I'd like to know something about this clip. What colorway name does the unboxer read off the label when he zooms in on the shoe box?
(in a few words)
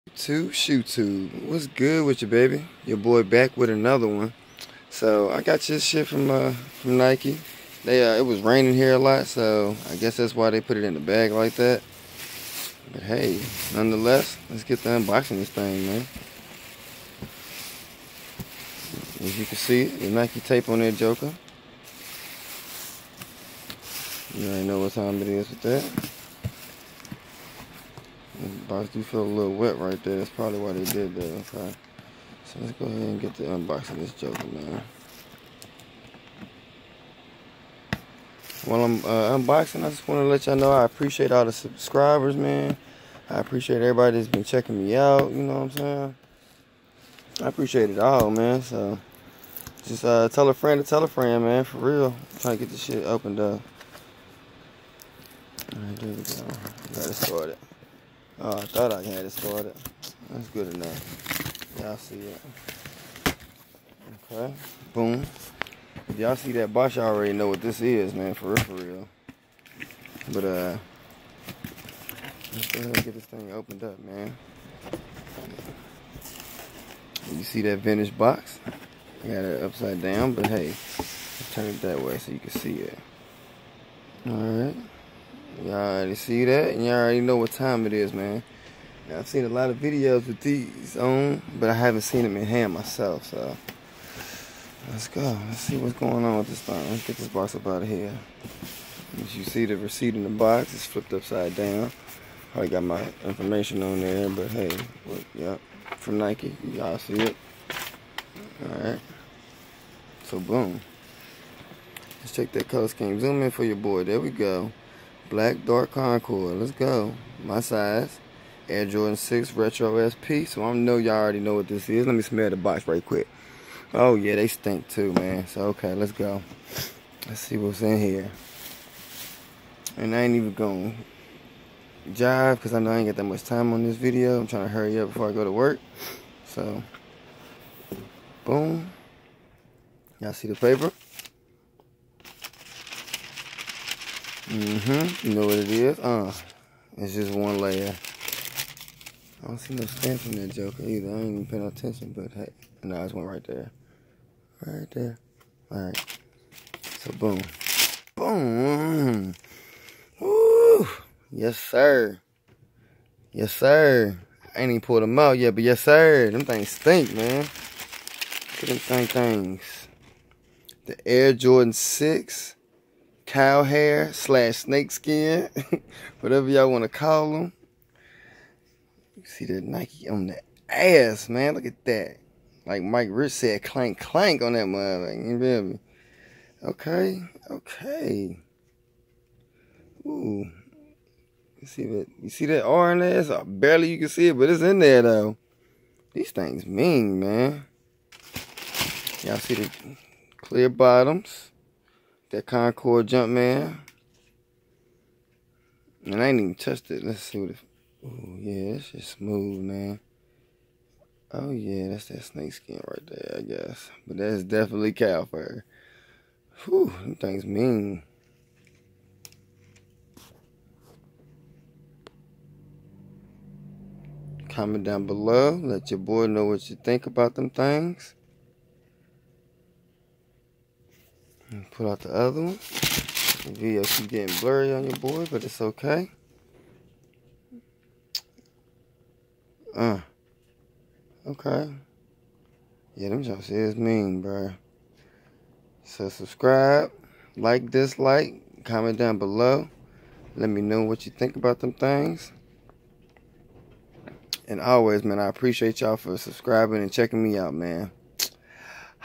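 Black Dark Concord.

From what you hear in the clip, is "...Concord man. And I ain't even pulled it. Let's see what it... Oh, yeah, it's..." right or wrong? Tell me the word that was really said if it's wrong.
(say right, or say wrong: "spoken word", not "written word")
wrong: "touched", not "pulled".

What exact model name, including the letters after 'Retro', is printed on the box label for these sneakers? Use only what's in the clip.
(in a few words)
Air Jordan 6 Retro SP.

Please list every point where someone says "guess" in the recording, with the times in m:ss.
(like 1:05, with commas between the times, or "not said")
0:09, 3:33.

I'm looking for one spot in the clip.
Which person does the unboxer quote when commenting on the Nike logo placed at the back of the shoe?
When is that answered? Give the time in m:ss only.
3:02.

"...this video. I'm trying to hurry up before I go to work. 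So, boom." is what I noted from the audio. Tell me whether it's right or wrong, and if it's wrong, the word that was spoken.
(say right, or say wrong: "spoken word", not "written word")
right.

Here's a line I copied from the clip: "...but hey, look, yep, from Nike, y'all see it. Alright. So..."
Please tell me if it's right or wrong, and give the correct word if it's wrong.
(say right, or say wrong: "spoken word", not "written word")
right.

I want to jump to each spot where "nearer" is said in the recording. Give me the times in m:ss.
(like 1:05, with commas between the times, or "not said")
not said.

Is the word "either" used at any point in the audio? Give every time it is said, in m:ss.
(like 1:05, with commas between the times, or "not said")
2:30.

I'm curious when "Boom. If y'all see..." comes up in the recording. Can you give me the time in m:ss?
1:04.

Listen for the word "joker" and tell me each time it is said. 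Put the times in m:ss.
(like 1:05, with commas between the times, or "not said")
0:20, 0:34, 2:30.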